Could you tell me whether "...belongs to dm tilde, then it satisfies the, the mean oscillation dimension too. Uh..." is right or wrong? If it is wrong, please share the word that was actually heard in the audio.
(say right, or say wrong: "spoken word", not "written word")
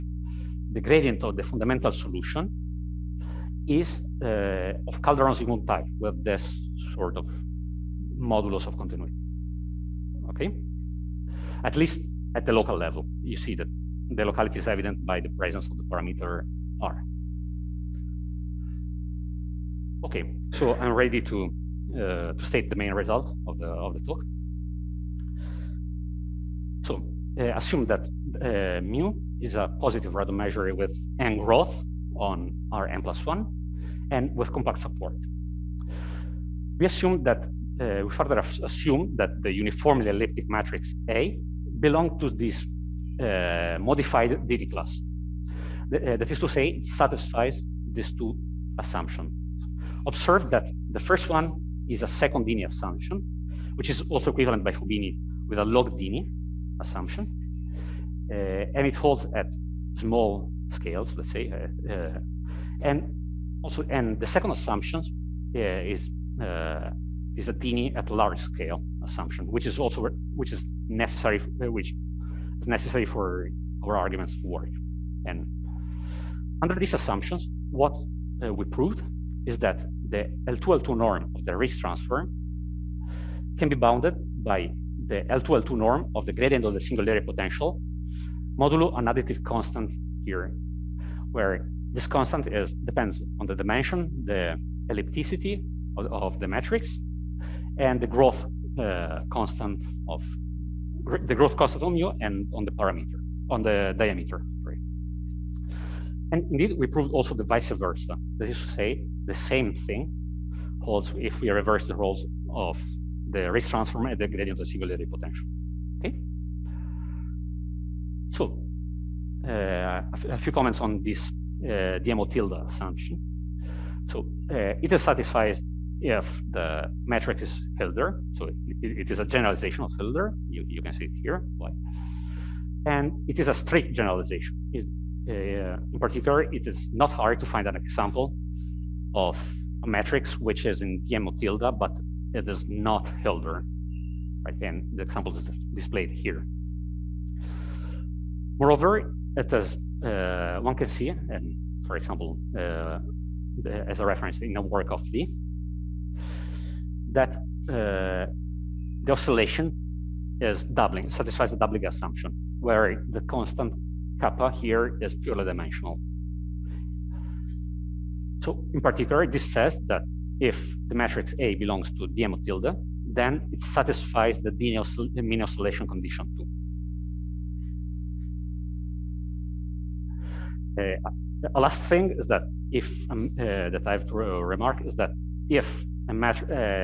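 wrong: "condition", not "dimension".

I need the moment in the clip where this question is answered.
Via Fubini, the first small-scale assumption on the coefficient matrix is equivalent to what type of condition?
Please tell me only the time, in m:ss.
0:55.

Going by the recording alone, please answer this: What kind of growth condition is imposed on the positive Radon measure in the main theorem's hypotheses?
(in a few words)
n growth.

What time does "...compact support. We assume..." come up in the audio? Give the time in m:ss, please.
0:34.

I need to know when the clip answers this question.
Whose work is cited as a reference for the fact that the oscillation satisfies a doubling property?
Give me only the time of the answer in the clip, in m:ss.
2:35.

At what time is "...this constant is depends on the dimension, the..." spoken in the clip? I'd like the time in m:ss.
1:31.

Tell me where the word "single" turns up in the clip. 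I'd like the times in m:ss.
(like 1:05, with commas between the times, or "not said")
1:26, 1:54.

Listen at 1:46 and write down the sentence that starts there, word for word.
And indeed, we proved also the vice versa.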